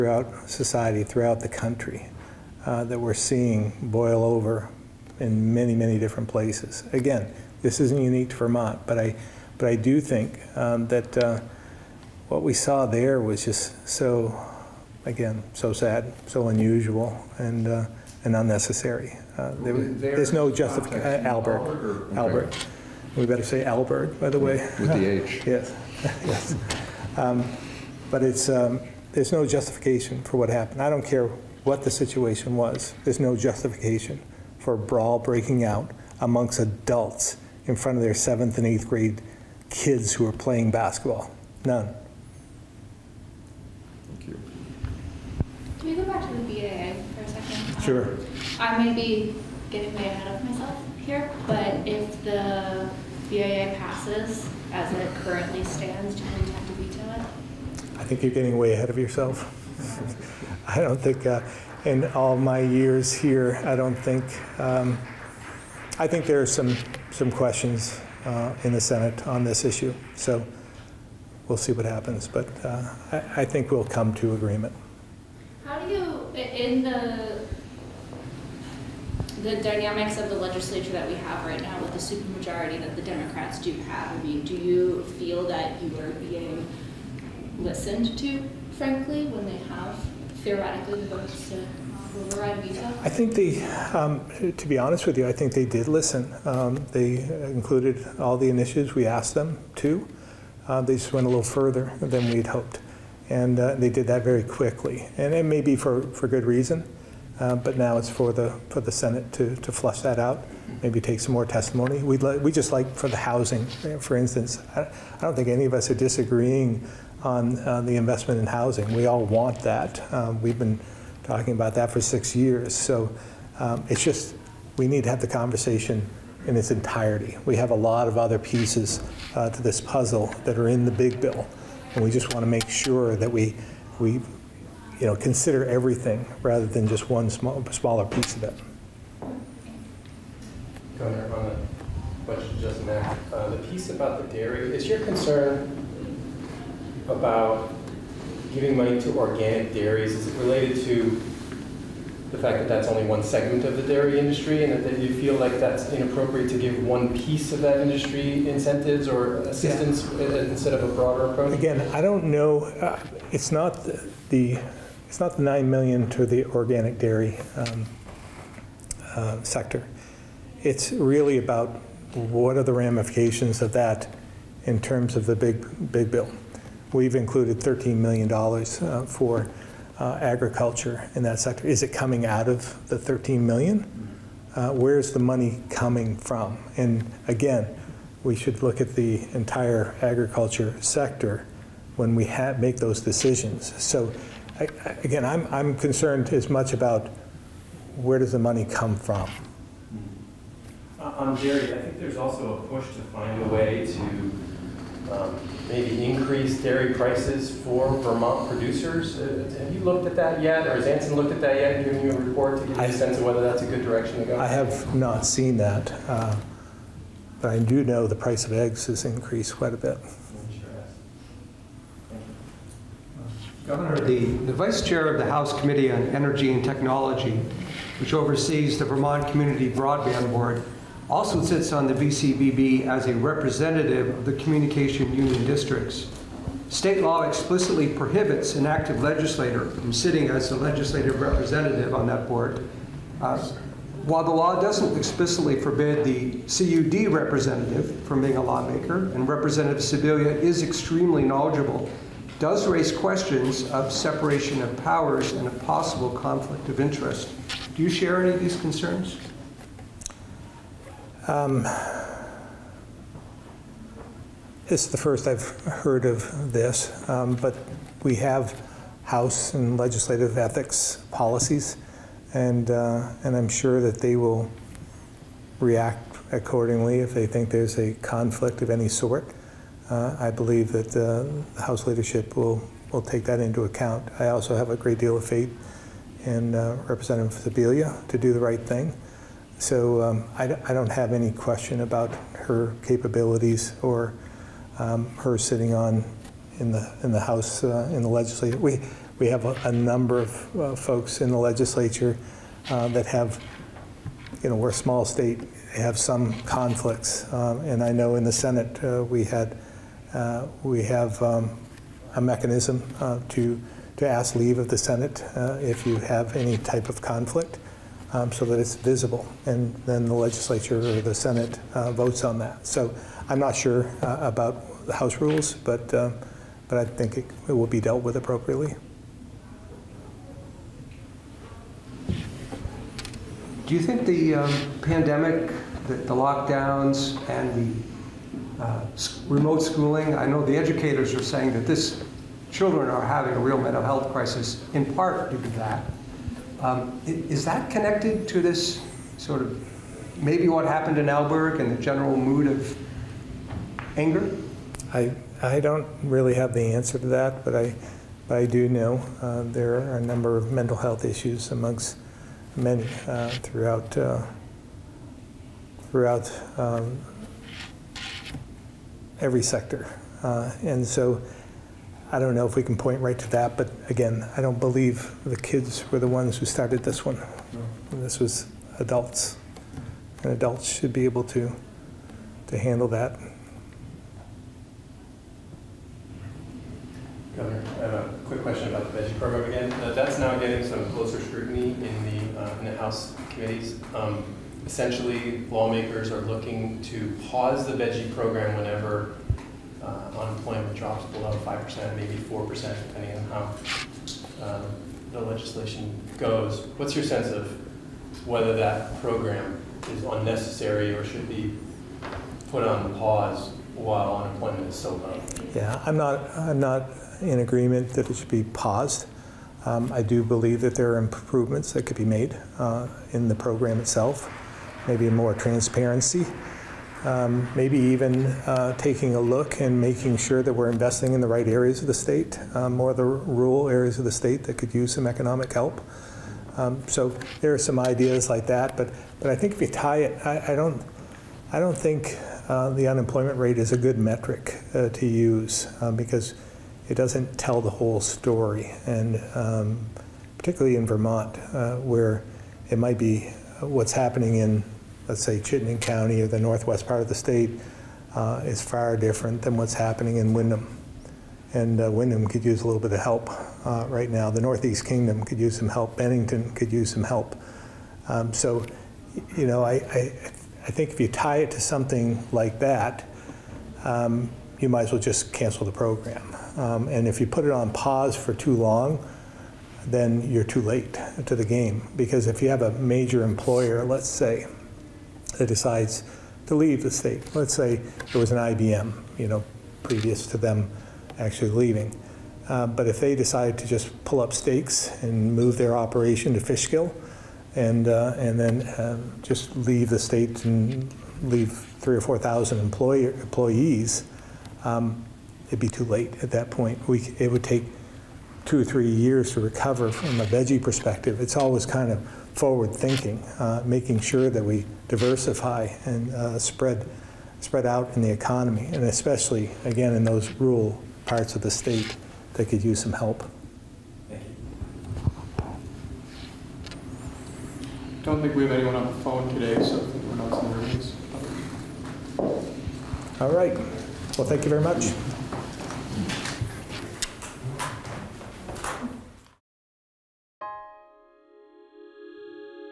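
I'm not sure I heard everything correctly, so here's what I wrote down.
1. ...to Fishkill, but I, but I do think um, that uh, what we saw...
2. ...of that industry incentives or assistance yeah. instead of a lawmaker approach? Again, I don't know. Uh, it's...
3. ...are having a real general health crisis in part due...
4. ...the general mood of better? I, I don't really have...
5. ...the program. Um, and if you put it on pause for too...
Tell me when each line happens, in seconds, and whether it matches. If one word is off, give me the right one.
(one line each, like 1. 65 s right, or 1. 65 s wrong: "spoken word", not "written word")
1. 8 s wrong: "Vermont", not "Fishkill"
2. 157 s wrong: "broader", not "lawmaker"
3. 342 s wrong: "mental", not "general"
4. 351 s wrong: "anger", not "better"
5. 475 s right.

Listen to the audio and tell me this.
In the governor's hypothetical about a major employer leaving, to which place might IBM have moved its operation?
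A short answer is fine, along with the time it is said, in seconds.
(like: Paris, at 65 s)
Fishkill, at 496 s.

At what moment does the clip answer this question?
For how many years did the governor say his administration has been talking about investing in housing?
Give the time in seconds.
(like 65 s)
122 s.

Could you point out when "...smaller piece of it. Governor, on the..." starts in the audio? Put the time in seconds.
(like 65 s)
137 s.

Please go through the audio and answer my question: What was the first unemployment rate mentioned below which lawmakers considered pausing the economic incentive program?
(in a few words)
5%.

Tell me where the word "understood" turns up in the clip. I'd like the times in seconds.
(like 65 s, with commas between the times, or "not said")
not said.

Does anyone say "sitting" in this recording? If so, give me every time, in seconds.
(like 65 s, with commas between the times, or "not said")
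239 s, 295 s.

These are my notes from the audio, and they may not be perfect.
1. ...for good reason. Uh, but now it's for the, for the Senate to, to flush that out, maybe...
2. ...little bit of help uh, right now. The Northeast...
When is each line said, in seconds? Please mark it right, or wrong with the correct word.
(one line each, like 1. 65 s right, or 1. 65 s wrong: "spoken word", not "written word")
1. 106 s right
2. 462 s right.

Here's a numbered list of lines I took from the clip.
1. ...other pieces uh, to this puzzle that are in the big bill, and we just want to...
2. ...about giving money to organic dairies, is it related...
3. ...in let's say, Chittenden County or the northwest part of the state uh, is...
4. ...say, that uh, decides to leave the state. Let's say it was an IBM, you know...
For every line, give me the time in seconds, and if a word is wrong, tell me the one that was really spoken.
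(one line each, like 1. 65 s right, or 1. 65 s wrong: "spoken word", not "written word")
1. 128 s right
2. 147 s right
3. 454 s right
4. 484 s right.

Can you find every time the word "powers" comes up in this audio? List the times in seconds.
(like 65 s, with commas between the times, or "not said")
254 s.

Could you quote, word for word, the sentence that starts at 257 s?
Do you share any of these concerns?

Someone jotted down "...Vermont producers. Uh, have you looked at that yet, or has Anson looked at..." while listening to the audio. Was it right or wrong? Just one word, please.
right.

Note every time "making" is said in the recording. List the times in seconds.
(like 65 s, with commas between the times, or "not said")
429 s, 513 s.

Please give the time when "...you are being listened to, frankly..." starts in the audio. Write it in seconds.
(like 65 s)
85 s.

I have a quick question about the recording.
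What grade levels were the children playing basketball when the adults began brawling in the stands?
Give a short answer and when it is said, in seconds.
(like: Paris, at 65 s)
7th and 8th grade, at 38 s.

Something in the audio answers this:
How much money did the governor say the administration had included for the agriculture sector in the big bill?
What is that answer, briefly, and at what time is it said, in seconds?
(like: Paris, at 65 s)
$13 million, at 177 s.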